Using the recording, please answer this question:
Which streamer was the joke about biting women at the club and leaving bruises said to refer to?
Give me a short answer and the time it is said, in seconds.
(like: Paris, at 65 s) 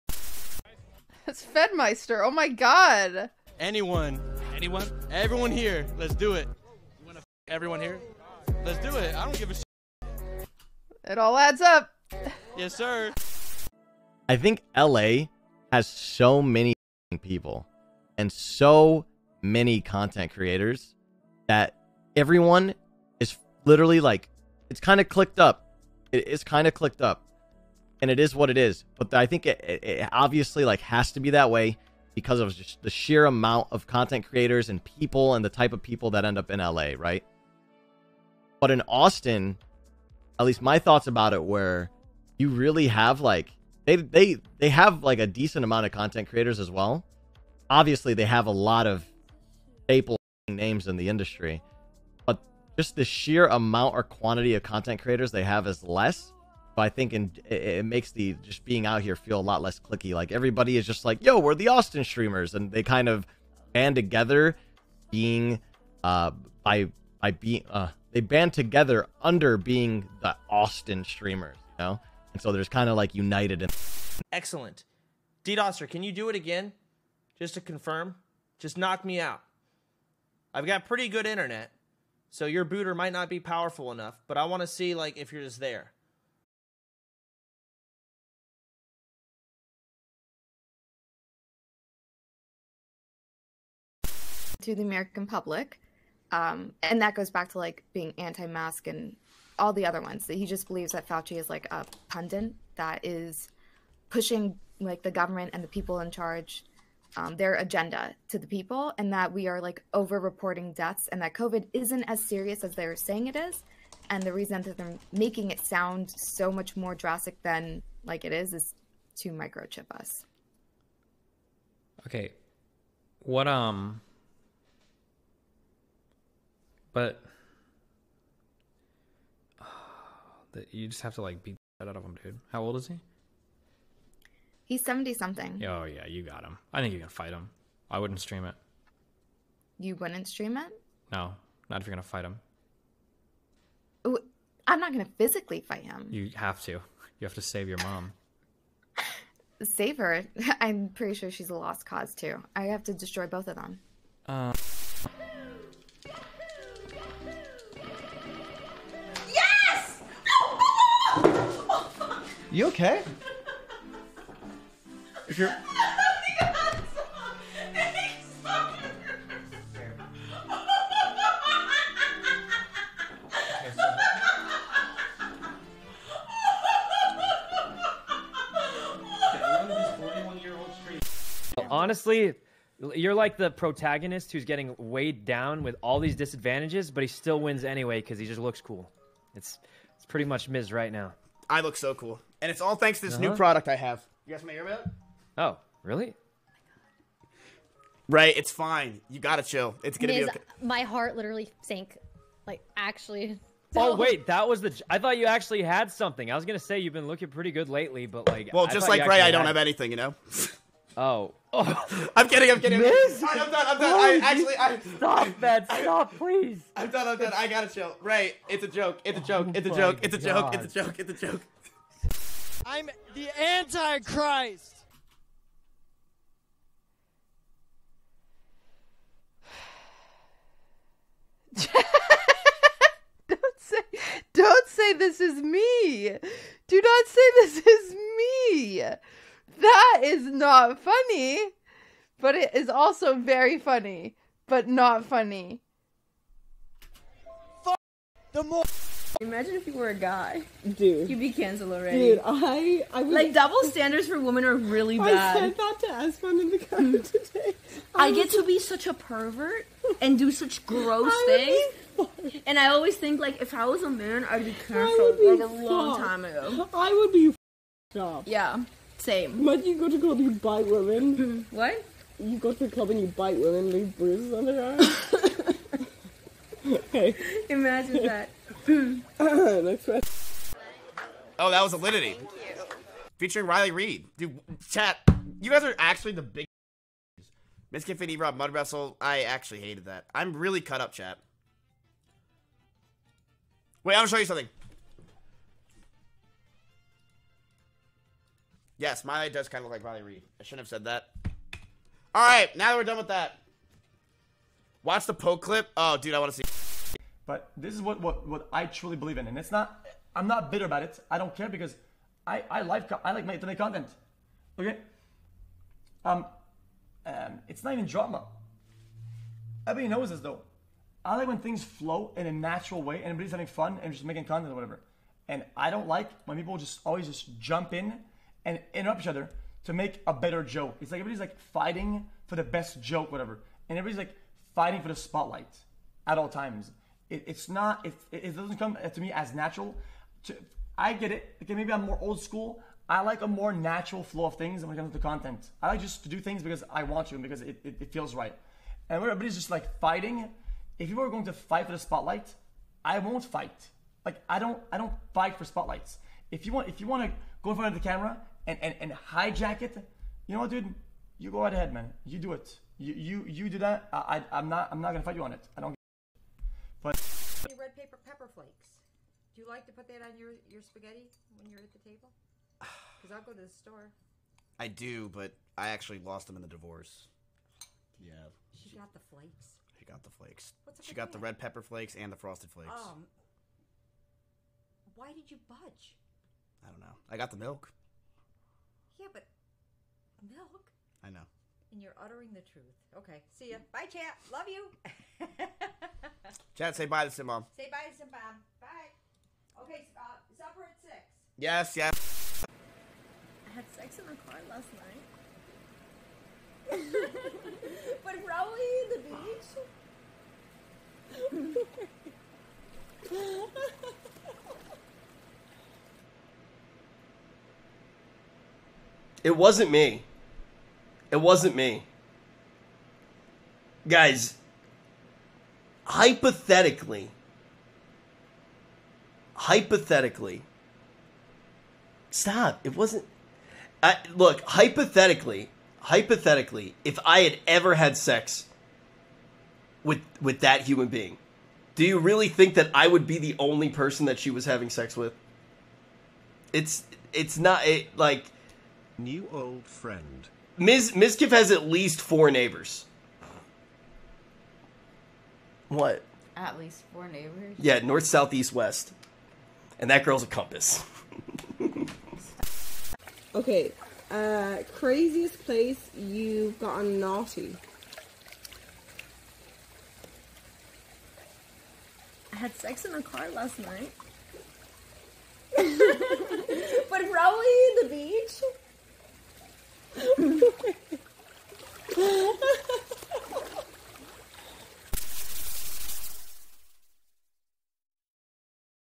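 Alinity, at 281 s.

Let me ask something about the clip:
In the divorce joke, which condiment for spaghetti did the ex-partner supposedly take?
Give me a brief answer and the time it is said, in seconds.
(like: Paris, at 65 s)
Red pepper flakes, at 381 s.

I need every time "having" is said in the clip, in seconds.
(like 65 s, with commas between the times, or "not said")
323 s, 444 s.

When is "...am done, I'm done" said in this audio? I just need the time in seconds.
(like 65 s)
213 s.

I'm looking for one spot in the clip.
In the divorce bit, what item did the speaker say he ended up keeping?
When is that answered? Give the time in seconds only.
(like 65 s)
387 s.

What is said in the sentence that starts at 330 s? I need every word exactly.
It's like everybody's like fighting for the best joke, whatever, and everybody's like fighting for the spotlight at all times.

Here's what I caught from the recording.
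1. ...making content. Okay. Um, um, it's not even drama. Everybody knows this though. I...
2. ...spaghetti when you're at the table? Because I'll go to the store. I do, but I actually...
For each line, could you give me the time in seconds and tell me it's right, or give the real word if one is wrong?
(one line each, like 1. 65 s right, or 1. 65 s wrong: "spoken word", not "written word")
1. 313 s right
2. 370 s right.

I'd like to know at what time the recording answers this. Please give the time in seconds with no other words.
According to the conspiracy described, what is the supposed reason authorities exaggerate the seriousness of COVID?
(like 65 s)
119 s.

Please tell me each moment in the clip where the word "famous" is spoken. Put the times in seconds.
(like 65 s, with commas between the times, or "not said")
not said.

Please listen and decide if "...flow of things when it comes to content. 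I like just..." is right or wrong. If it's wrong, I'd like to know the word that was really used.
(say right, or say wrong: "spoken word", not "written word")
right.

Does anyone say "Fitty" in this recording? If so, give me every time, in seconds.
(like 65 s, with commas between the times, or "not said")
287 s.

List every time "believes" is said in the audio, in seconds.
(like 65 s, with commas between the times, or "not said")
100 s, 308 s.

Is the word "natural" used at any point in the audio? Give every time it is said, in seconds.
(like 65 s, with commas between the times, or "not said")
322 s, 339 s, 343 s.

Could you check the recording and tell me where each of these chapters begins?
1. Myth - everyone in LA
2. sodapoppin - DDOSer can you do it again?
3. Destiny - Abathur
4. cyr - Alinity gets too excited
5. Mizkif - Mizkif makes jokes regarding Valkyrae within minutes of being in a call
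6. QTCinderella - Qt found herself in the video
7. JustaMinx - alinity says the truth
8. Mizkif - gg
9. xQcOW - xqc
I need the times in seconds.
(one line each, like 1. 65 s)
1. 13 s
2. 74 s
3. 94 s
4. 155 s
5. 181 s
6. 222 s
7. 249 s
8. 280 s
9. 307 s.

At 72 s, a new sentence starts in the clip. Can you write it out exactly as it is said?
And so there's kind of like united and excellent.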